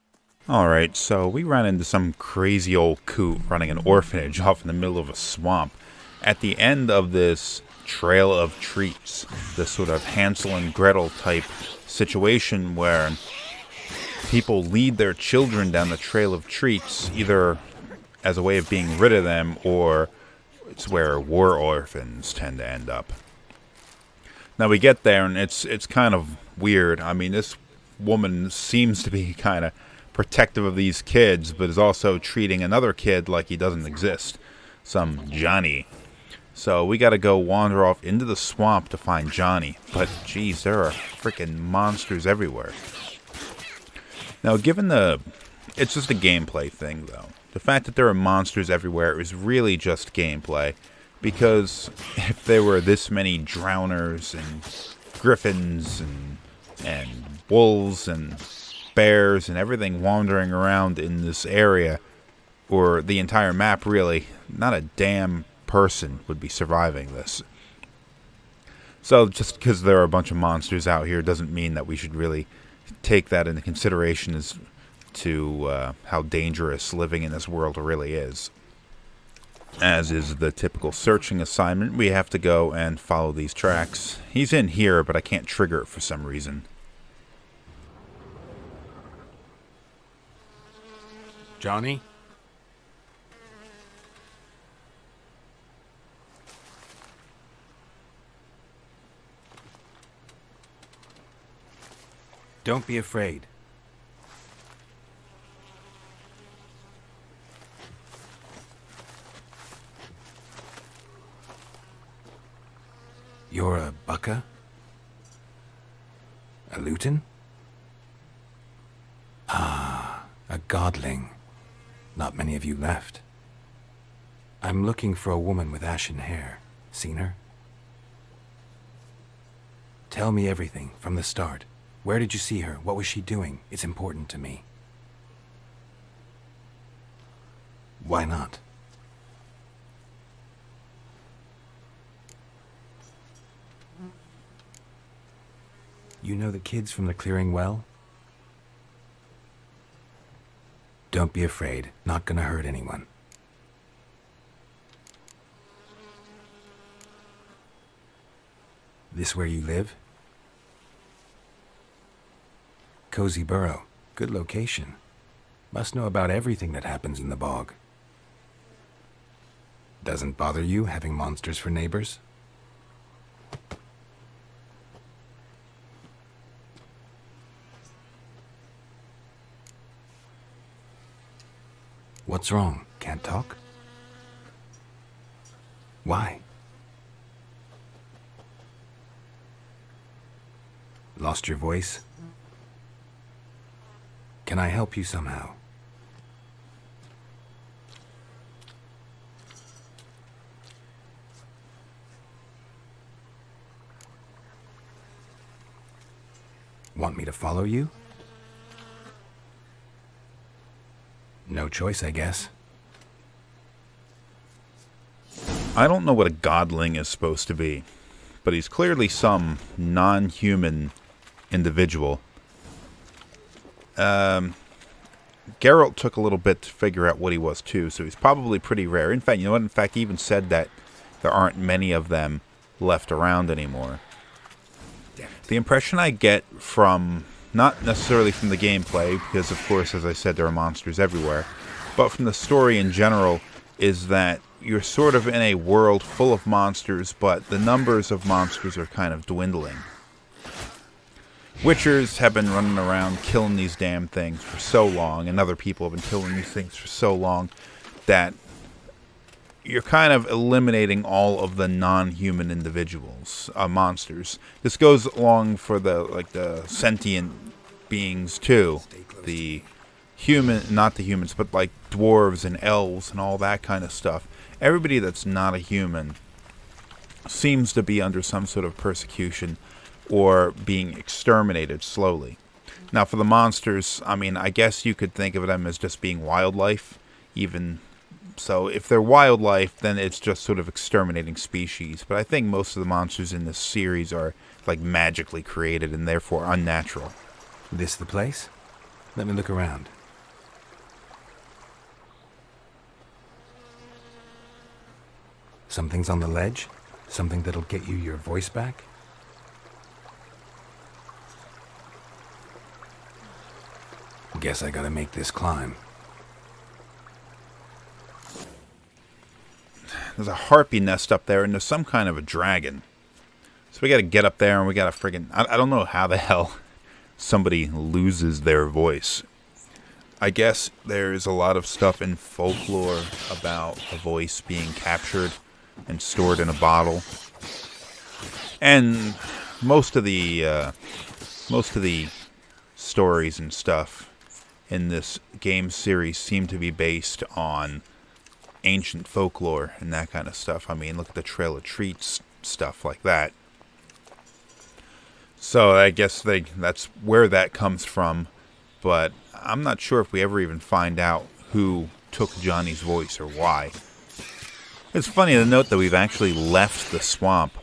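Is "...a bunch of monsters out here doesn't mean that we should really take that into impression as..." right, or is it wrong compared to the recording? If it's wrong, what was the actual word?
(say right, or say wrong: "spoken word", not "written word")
wrong: "consideration", not "impression".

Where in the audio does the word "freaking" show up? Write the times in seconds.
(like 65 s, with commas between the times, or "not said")
40 s.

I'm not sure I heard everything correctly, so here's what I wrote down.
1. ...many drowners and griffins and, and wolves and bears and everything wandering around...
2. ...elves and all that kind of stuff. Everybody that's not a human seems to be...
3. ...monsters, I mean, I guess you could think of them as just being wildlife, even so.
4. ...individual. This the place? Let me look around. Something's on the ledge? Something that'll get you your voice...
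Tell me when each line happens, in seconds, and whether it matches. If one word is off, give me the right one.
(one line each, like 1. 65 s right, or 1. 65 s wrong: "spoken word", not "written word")
1. 53 s right
2. 272 s right
3. 283 s right
4. 296 s wrong: "unnatural", not "individual".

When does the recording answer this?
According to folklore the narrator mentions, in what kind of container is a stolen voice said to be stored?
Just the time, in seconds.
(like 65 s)
336 s.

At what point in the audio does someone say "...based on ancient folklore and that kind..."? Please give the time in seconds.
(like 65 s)
346 s.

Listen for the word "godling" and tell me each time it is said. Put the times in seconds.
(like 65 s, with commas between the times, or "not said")
120 s, 216 s.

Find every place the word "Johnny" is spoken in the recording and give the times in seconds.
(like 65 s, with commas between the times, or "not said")
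35 s, 39 s, 91 s, 362 s.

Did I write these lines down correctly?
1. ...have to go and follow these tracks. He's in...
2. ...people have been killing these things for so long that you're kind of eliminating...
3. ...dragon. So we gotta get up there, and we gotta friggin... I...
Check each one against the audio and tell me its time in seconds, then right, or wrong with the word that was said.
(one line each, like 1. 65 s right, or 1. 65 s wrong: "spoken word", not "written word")
1. 82 s right
2. 255 s right
3. 322 s right.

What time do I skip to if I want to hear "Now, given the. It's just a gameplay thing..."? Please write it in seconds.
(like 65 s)
44 s.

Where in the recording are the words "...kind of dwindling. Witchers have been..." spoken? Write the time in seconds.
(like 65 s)
248 s.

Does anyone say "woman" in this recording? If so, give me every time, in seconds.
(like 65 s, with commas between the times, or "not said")
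27 s, 125 s.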